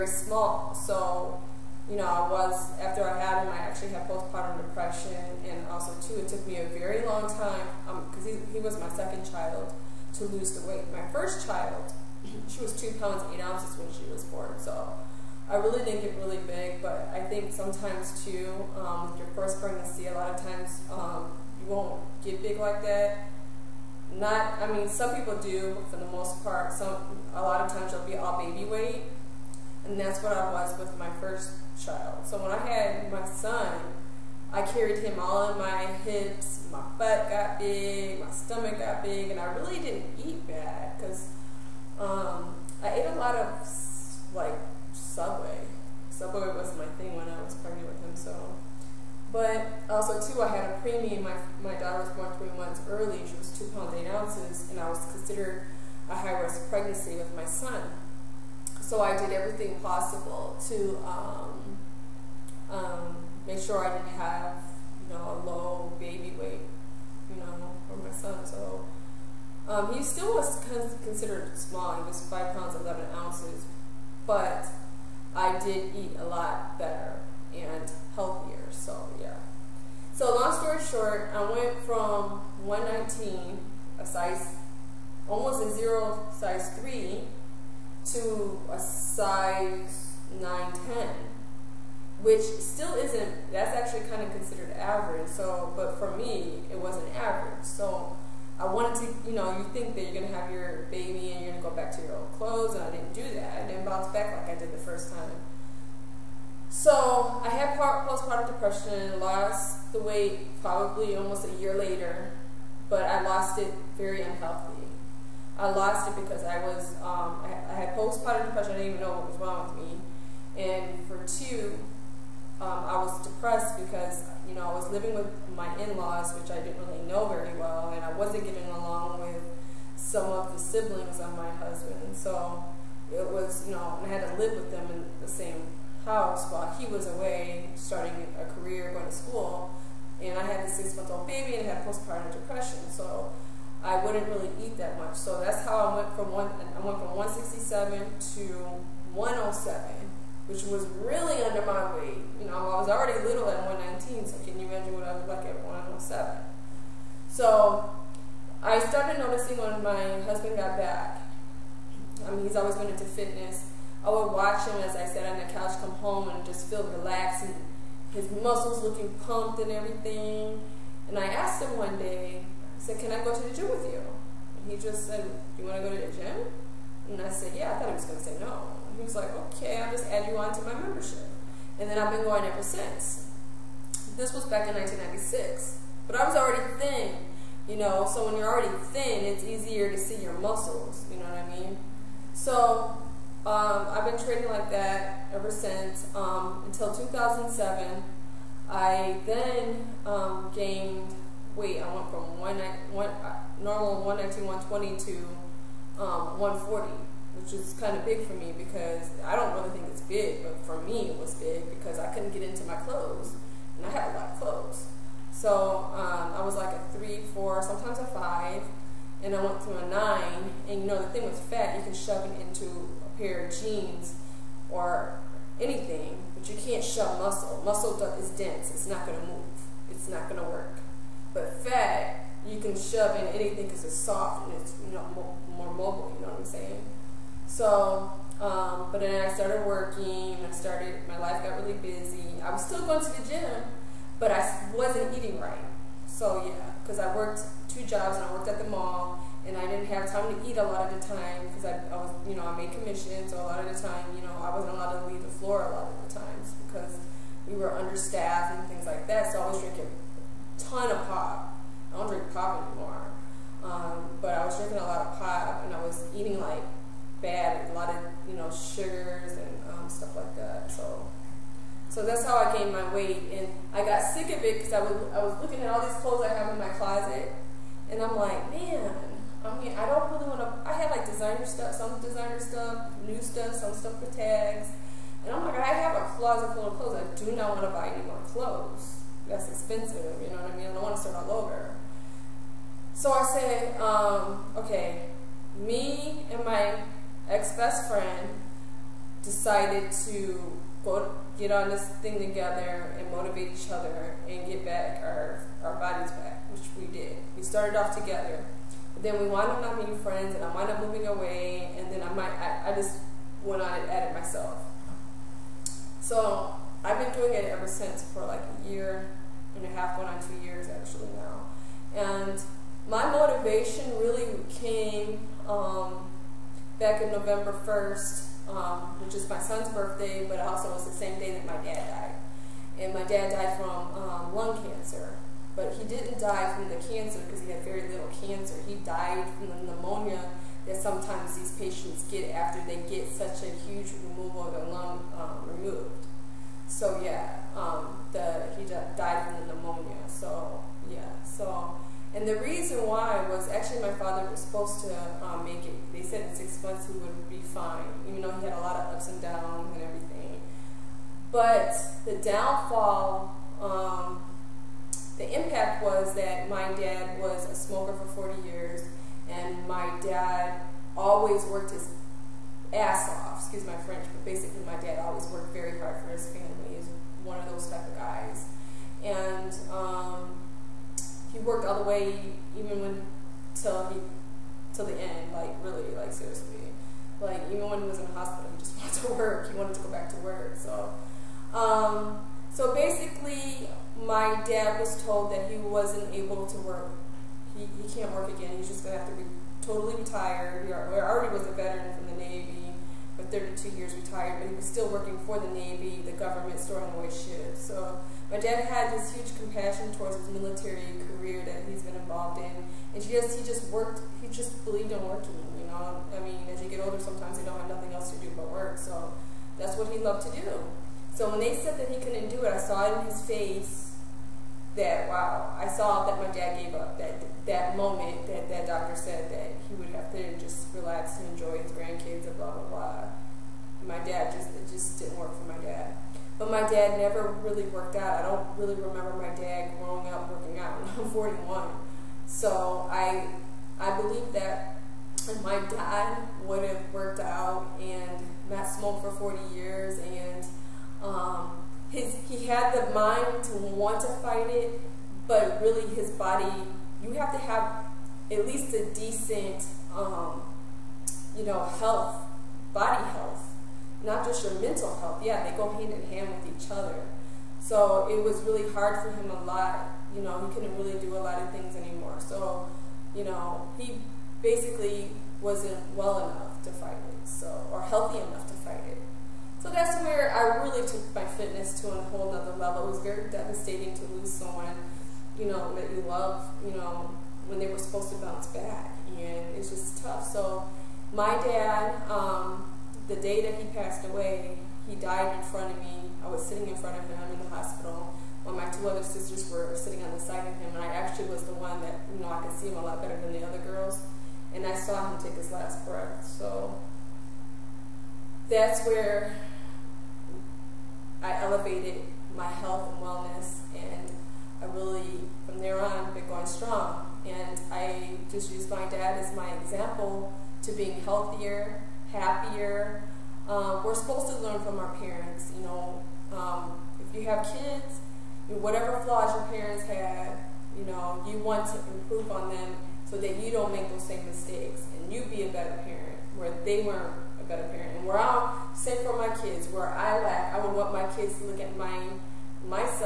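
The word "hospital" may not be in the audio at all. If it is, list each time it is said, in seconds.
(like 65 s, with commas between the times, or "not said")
388 s, 497 s.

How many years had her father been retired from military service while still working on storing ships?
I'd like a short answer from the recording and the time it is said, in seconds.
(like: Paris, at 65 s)
32, at 403 s.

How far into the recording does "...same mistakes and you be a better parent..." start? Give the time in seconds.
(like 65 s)
534 s.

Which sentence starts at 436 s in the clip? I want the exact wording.
But my dad never really worked out.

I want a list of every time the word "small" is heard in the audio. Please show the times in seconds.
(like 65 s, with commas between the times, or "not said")
0 s, 71 s.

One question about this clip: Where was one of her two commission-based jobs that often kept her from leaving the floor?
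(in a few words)
the mall.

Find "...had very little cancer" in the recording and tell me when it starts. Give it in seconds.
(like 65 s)
337 s.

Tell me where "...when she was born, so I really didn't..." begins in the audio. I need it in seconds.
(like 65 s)
13 s.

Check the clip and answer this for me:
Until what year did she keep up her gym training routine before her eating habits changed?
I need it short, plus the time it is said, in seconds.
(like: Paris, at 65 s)
2007, at 196 s.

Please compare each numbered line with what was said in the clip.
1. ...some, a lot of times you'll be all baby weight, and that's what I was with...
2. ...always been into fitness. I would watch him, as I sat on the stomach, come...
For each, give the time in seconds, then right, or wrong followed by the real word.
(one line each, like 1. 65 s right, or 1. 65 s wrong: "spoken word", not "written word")
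1. 26 s right
2. 162 s wrong: "couch", not "stomach".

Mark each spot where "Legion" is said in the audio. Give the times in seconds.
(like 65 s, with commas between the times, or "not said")
not said.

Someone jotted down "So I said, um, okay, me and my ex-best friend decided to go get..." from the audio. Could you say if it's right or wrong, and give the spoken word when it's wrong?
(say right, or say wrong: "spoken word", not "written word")
right.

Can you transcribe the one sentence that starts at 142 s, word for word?
So I wouldn't really eat that much.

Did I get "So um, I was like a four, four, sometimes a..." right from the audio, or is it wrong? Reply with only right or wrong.
wrong.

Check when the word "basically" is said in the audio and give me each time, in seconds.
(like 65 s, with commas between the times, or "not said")
374 s, 392 s, 474 s.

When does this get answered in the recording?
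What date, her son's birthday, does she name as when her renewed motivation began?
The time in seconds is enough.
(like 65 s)
327 s.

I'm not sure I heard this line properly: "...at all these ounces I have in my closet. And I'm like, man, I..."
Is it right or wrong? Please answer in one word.
wrong.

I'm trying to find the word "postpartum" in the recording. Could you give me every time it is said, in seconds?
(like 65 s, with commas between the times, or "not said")
4 s, 107 s, 117 s, 141 s.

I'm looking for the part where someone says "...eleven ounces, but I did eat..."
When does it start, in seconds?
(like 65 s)
72 s.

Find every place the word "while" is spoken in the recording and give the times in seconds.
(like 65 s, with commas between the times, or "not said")
136 s, 498 s.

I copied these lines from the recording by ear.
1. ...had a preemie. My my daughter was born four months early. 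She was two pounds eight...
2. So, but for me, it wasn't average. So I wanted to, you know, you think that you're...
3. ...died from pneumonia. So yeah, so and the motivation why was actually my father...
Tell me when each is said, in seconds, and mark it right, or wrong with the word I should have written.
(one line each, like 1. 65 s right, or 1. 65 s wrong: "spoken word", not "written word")
1. 50 s wrong: "three", not "four"
2. 95 s right
3. 348 s wrong: "reason", not "motivation".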